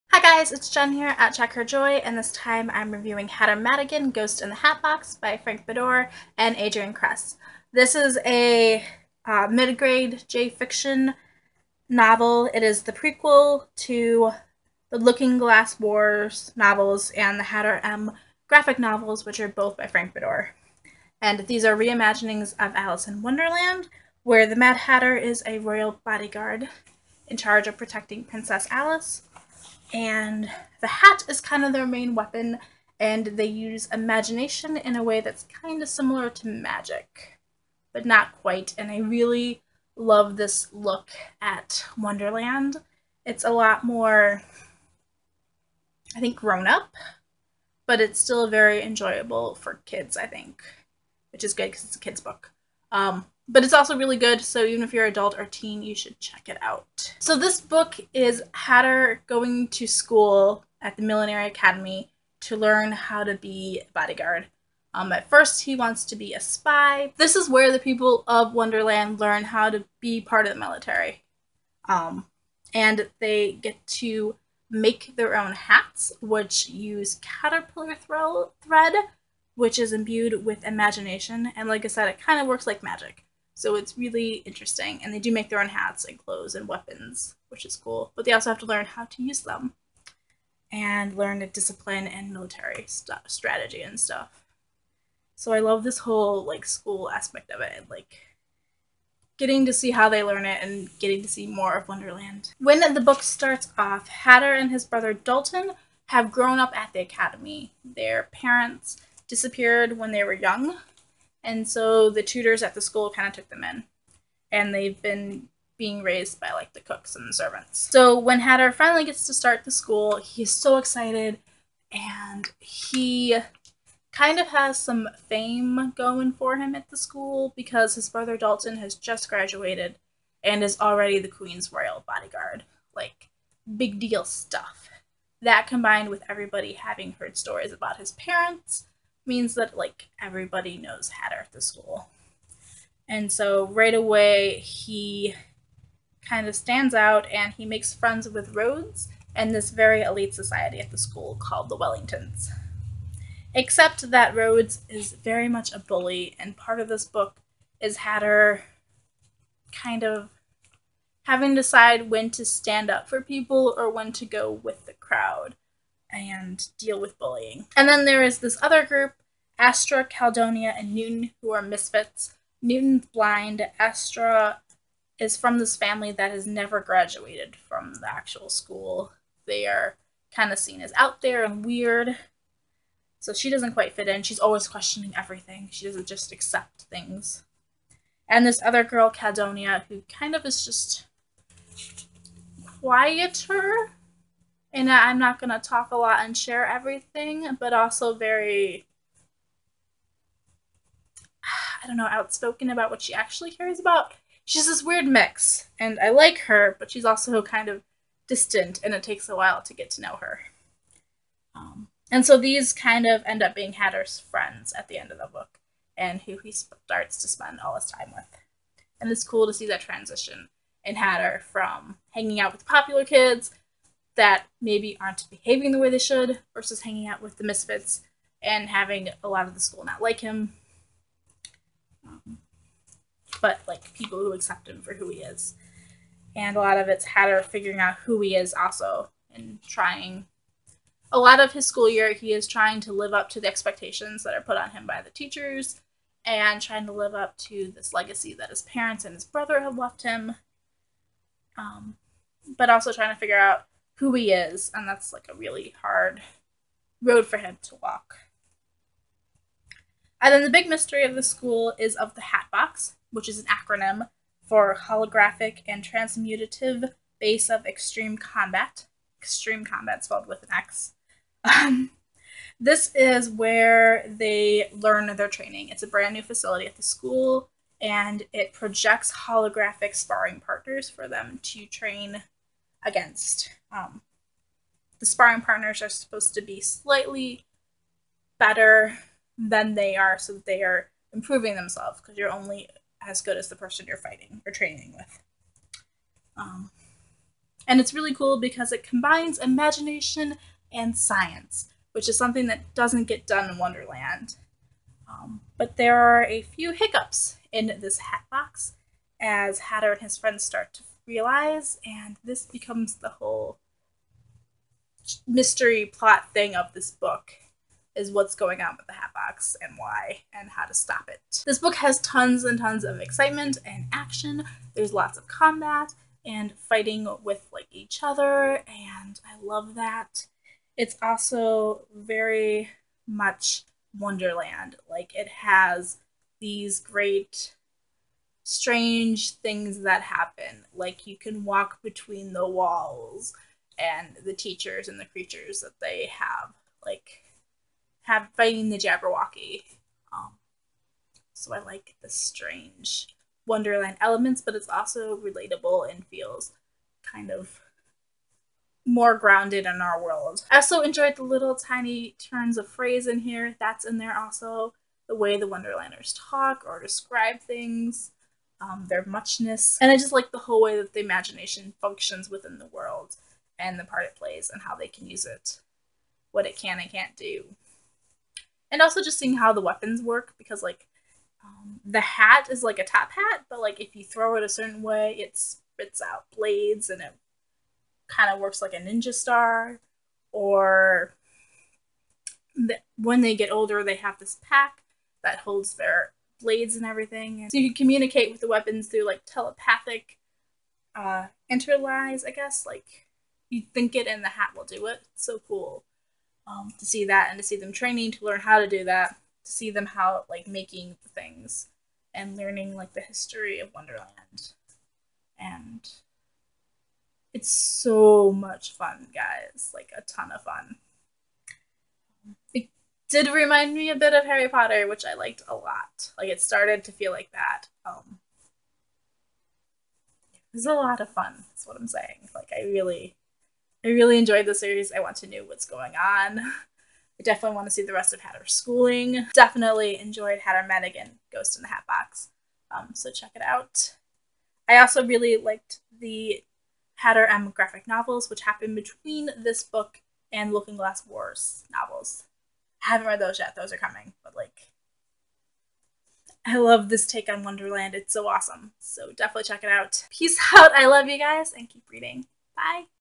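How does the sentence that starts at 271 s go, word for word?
Um, this is where they learn their training.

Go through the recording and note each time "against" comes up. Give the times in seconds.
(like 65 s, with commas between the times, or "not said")
282 s.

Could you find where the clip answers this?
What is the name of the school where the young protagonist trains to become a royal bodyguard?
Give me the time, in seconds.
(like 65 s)
61 s.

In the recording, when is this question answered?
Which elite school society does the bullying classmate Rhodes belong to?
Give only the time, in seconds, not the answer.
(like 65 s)
151 s.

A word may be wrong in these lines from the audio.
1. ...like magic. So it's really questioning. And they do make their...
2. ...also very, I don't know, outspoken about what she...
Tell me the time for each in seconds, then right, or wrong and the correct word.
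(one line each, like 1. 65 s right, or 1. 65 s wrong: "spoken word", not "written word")
1. 82 s wrong: "interesting", not "questioning"
2. 197 s right.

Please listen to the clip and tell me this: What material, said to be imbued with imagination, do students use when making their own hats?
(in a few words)
caterpillar thread.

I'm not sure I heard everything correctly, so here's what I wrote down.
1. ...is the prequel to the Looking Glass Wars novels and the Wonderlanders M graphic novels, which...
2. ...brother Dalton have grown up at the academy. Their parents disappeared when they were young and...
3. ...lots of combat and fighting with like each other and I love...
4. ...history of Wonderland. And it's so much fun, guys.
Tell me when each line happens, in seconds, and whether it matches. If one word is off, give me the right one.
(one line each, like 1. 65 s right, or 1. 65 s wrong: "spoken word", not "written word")
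1. 12 s wrong: "Hatter", not "Wonderlanders"
2. 104 s right
3. 324 s right
4. 413 s right.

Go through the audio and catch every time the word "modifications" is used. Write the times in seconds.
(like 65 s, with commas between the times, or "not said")
not said.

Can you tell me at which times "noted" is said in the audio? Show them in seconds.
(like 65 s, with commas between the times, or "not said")
not said.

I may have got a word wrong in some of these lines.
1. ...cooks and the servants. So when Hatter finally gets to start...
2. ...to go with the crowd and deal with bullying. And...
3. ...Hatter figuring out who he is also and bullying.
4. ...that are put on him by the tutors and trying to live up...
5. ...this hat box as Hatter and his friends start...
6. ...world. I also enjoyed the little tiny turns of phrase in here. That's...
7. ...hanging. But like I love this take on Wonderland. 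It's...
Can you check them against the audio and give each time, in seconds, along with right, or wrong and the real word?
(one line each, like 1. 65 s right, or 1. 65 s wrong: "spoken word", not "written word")
1. 116 s right
2. 164 s right
3. 237 s wrong: "trying", not "bullying"
4. 244 s wrong: "teachers", not "tutors"
5. 307 s right
6. 360 s right
7. 453 s wrong: "coming", not "hanging".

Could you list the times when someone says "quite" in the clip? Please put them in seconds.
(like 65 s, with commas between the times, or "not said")
38 s, 183 s.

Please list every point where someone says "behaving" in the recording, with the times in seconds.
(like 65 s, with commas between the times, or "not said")
225 s.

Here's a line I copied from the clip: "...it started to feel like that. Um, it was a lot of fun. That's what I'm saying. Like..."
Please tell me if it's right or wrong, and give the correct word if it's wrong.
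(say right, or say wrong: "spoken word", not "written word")
right.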